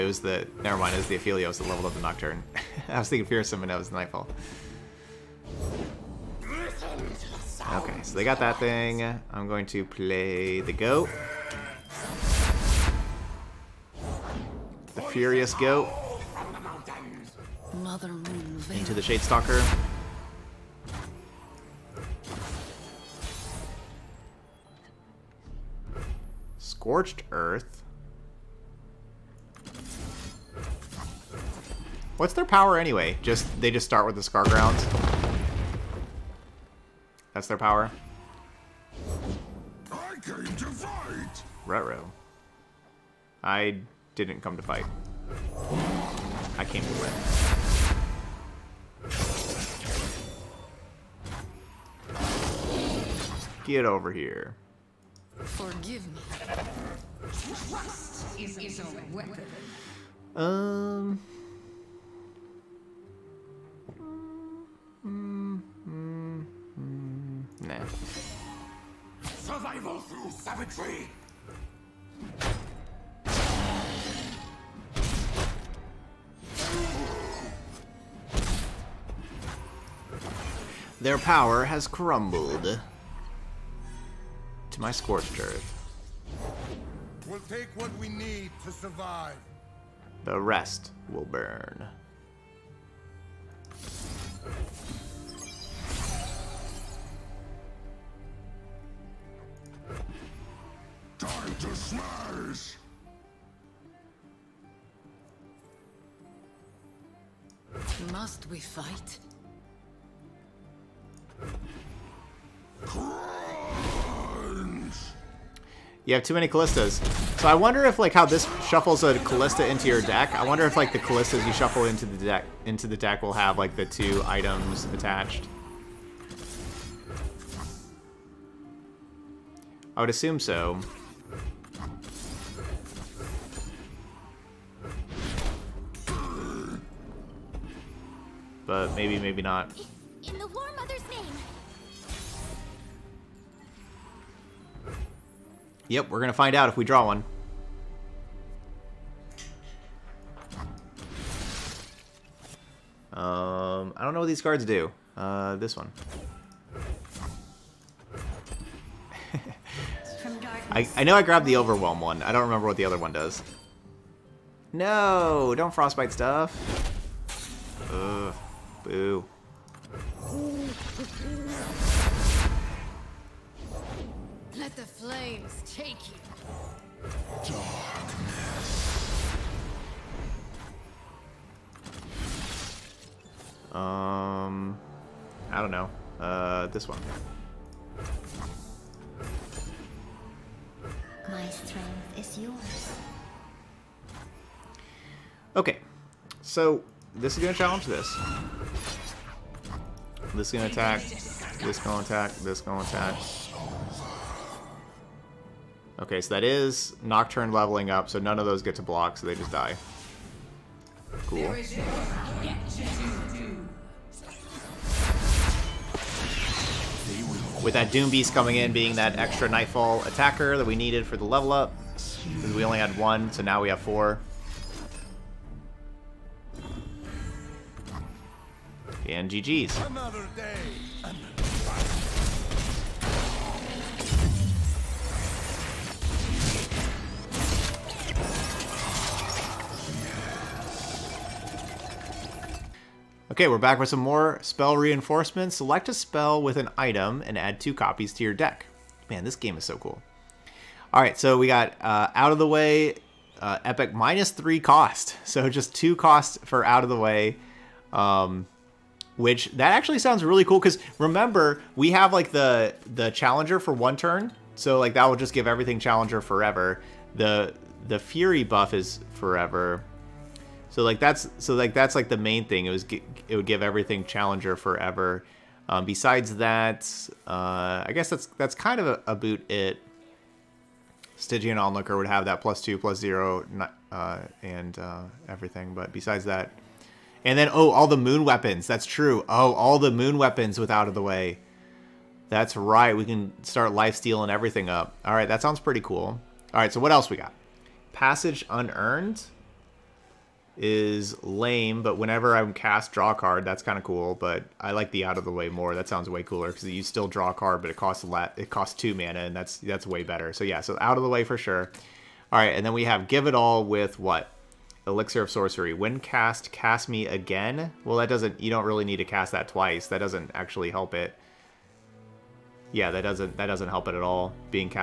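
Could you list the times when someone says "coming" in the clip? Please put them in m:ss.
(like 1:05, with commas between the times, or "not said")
3:38.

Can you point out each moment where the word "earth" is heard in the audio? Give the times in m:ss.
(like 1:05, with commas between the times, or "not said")
0:27, 1:25.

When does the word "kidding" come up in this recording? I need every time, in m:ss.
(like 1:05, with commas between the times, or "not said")
not said.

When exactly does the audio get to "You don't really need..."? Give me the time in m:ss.
5:18.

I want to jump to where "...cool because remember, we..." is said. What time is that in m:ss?
4:20.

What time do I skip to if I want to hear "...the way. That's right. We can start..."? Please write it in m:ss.
4:50.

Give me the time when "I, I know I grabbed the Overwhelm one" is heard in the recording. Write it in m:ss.
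2:40.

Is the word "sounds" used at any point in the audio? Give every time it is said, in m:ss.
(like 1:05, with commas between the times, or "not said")
4:19, 4:55, 5:05.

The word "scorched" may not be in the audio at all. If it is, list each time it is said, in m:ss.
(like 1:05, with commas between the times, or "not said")
0:26, 1:24.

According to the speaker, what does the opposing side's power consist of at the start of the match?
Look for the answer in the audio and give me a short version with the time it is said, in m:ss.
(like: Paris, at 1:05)
the Scargrounds, at 0:34.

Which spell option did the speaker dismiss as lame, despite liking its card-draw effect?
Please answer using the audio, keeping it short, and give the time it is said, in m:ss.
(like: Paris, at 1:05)
Passage Unearned, at 4:57.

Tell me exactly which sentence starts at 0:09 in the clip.
I'm going to play the Goat.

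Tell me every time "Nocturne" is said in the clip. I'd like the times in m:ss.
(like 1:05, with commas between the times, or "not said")
0:02, 3:27.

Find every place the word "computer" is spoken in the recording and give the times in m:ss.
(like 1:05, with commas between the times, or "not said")
not said.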